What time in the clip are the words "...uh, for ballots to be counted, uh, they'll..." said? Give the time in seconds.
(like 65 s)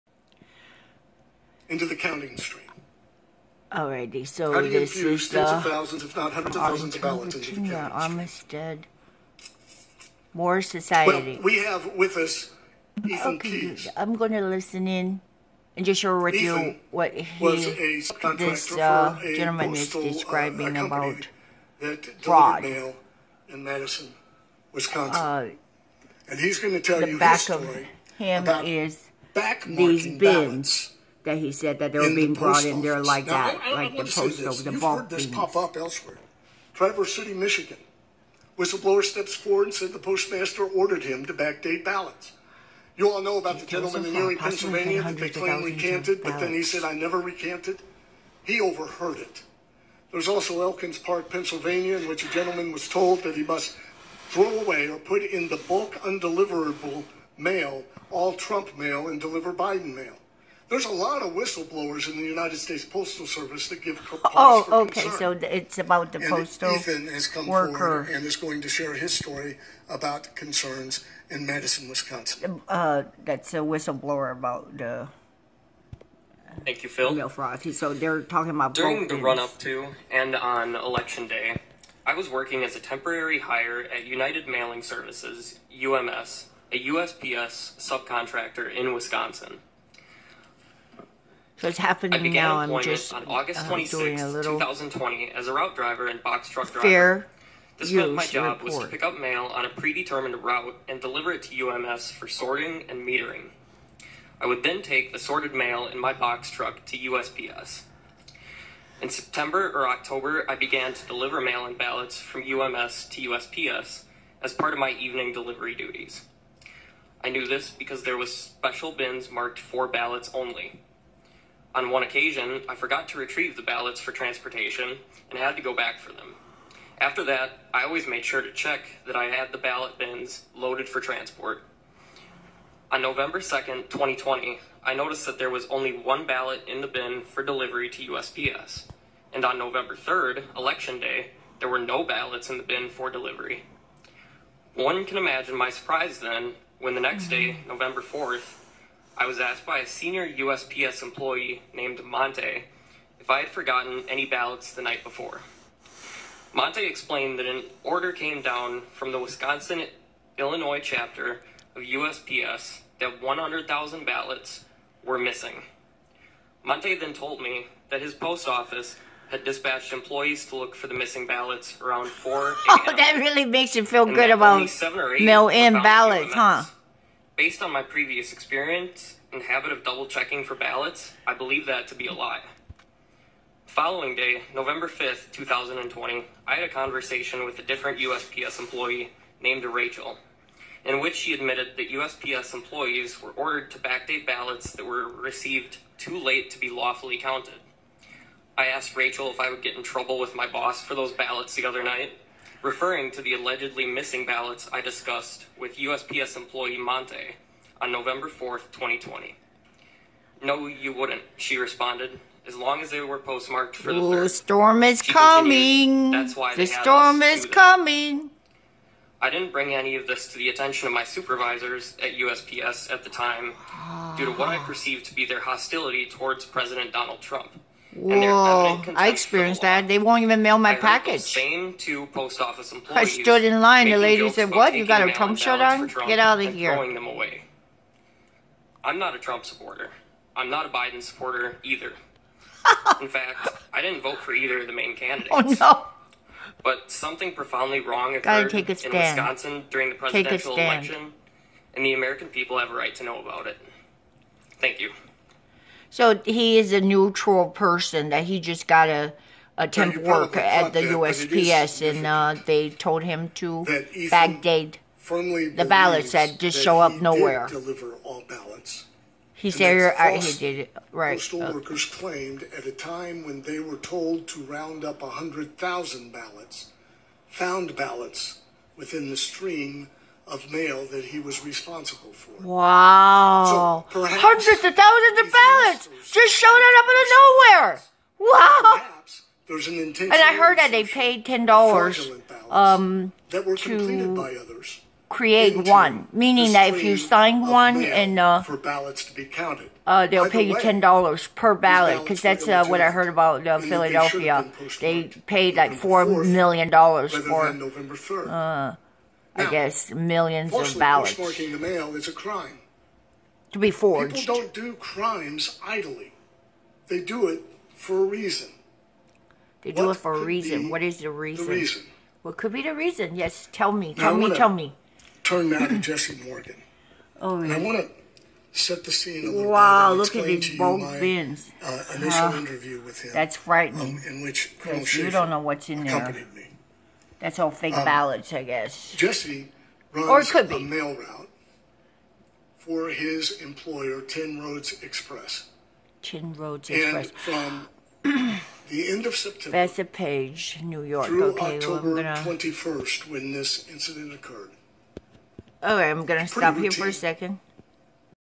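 298 s.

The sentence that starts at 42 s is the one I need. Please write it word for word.
You all know about the gentleman in Erie, Pennsylvania that they claim recanted, but then he said, I never recanted.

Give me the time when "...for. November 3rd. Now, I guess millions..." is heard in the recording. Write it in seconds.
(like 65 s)
307 s.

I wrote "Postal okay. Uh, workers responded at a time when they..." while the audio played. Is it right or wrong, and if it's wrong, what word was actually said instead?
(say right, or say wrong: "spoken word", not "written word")
wrong: "claimed", not "responded".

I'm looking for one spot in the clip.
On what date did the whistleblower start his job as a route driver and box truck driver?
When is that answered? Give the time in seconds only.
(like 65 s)
93 s.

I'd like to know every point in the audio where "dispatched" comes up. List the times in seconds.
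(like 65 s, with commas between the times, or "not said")
169 s.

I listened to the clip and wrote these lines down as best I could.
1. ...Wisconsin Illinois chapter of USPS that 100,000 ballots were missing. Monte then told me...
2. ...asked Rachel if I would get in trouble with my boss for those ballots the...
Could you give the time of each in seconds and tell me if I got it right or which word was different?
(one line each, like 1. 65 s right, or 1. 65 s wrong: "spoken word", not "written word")
1. 159 s right
2. 198 s right.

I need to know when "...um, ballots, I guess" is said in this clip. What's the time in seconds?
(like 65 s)
337 s.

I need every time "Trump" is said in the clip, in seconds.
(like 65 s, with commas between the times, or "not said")
58 s, 227 s, 235 s, 239 s.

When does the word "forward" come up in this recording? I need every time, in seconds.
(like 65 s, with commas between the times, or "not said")
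39 s, 67 s.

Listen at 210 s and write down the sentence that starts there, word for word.
No, you wouldn't, she responded, as long as they were postmarked for the Ooh, the storm is she coming.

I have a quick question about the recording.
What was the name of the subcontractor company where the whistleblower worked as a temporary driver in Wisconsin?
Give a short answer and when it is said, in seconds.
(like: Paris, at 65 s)
United Mailing Services, at 84 s.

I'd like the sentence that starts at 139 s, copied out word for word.
And on November 3rd, Election Day, there were no ballots in the bin for delivery.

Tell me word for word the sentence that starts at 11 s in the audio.
Well, we have with us Ethan okay, Keys.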